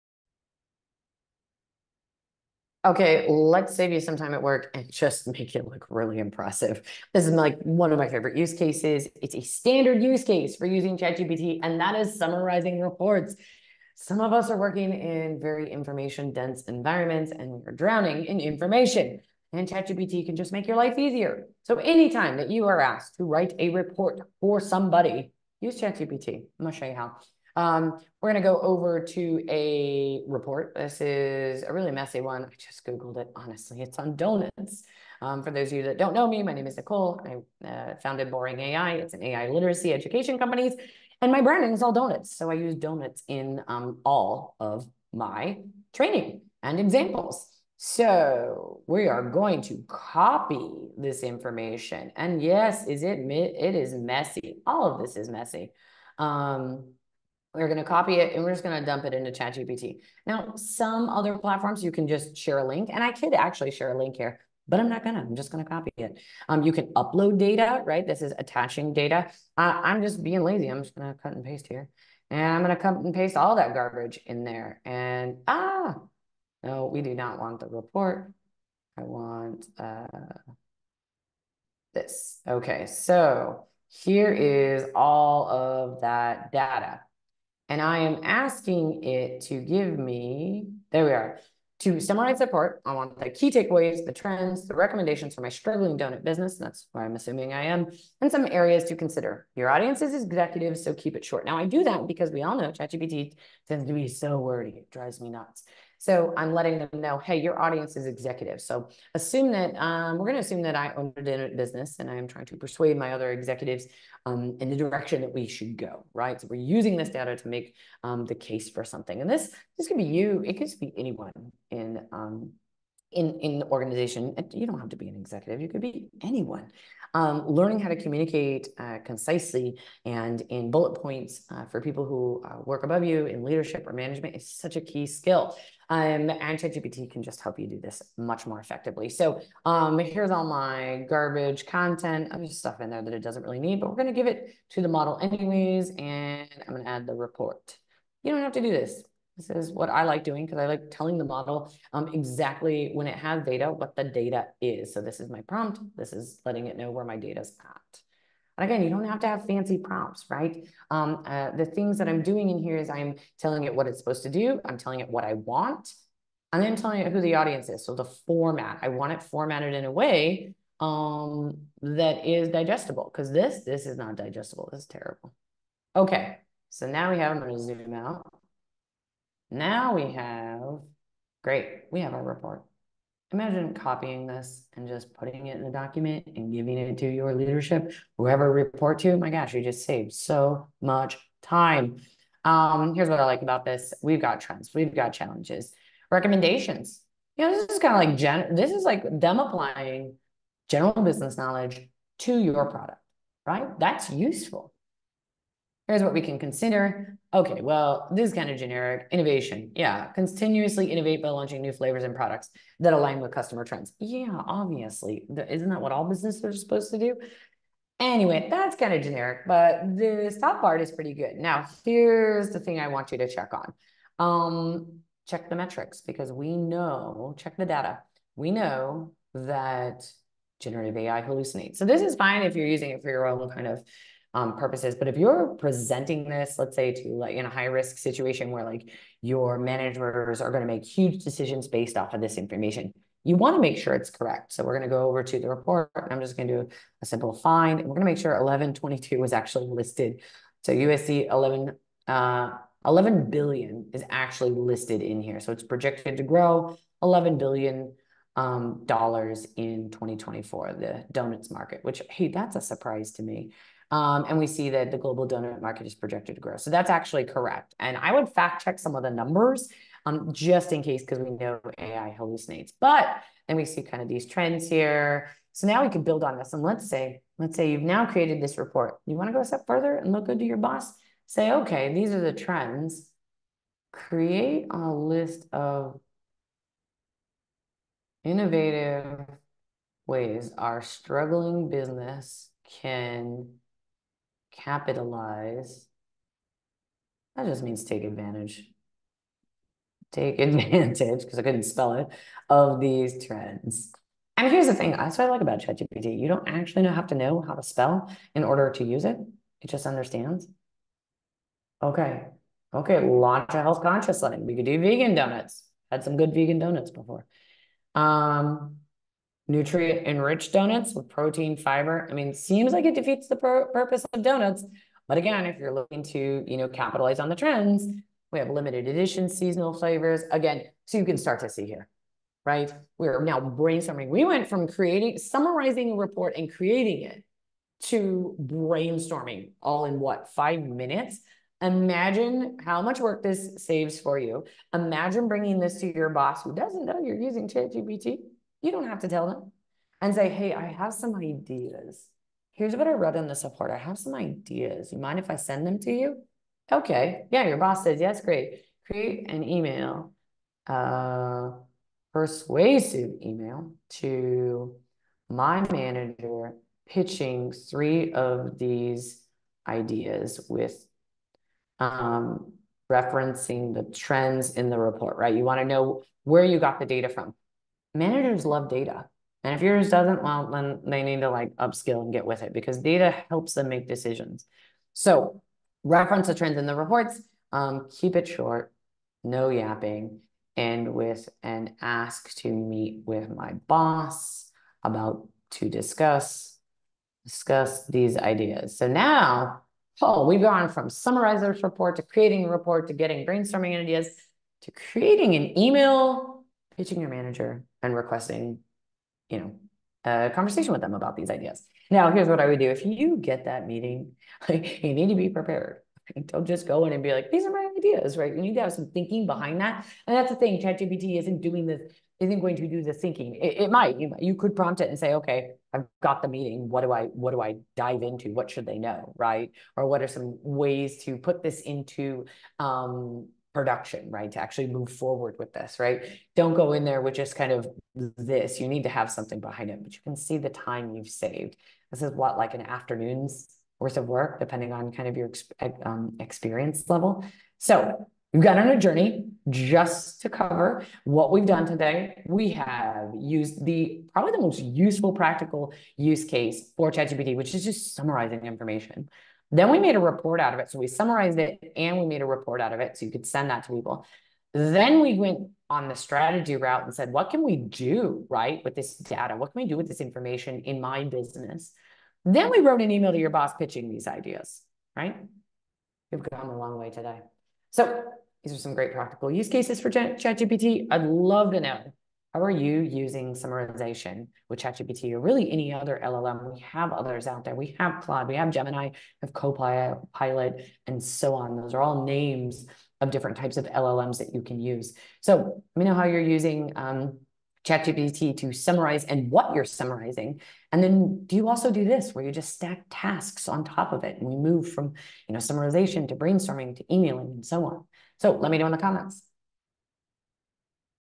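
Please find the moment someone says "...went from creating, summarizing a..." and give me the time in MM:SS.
05:34.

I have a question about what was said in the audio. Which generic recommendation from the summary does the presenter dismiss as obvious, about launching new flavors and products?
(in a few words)
Innovation.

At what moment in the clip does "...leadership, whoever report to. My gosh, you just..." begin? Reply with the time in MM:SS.
03:07.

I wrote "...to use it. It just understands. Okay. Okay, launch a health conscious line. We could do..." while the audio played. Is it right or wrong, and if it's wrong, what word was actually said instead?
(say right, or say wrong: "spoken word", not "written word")
right.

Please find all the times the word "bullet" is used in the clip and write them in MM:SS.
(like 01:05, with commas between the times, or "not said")
02:10.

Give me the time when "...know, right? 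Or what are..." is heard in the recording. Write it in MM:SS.
07:08.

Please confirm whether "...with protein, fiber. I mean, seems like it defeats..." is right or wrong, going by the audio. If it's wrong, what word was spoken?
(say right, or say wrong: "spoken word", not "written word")
right.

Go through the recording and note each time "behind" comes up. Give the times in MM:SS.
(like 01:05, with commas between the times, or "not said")
06:59, 07:19.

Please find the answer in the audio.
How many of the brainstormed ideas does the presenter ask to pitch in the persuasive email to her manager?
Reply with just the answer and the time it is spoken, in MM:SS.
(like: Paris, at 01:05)
3, at 06:07.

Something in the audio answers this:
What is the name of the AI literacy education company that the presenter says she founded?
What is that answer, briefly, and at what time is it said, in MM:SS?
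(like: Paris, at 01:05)
Boring AI, at 00:38.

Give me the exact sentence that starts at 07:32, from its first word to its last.
We have used the probably the most useful practical use case for ChatGPT, which is just summarizing information.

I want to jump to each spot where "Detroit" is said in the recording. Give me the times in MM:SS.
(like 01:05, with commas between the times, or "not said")
not said.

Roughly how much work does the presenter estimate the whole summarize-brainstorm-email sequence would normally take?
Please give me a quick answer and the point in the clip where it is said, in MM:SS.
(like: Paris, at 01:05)
An afternoon, at 07:22.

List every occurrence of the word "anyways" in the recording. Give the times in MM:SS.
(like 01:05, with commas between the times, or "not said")
02:25, 03:37.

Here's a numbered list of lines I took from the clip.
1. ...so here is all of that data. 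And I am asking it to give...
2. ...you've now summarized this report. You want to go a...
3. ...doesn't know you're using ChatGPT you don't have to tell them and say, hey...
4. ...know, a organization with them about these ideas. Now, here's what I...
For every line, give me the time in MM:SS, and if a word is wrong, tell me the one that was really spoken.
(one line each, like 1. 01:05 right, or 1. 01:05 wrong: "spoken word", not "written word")
1. 01:22 right
2. 04:37 wrong: "created", not "summarized"
3. 05:46 right
4. 06:49 wrong: "conversation", not "organization".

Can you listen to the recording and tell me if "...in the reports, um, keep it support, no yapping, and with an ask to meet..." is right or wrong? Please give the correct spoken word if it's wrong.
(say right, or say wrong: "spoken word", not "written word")
wrong: "short", not "support".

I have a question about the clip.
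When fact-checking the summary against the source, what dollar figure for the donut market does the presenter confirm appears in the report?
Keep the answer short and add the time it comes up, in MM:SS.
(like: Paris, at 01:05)
USD 11 billion, at 04:10.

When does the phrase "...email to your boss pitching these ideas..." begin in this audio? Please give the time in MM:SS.
07:52.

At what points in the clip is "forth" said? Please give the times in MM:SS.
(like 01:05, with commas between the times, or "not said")
not said.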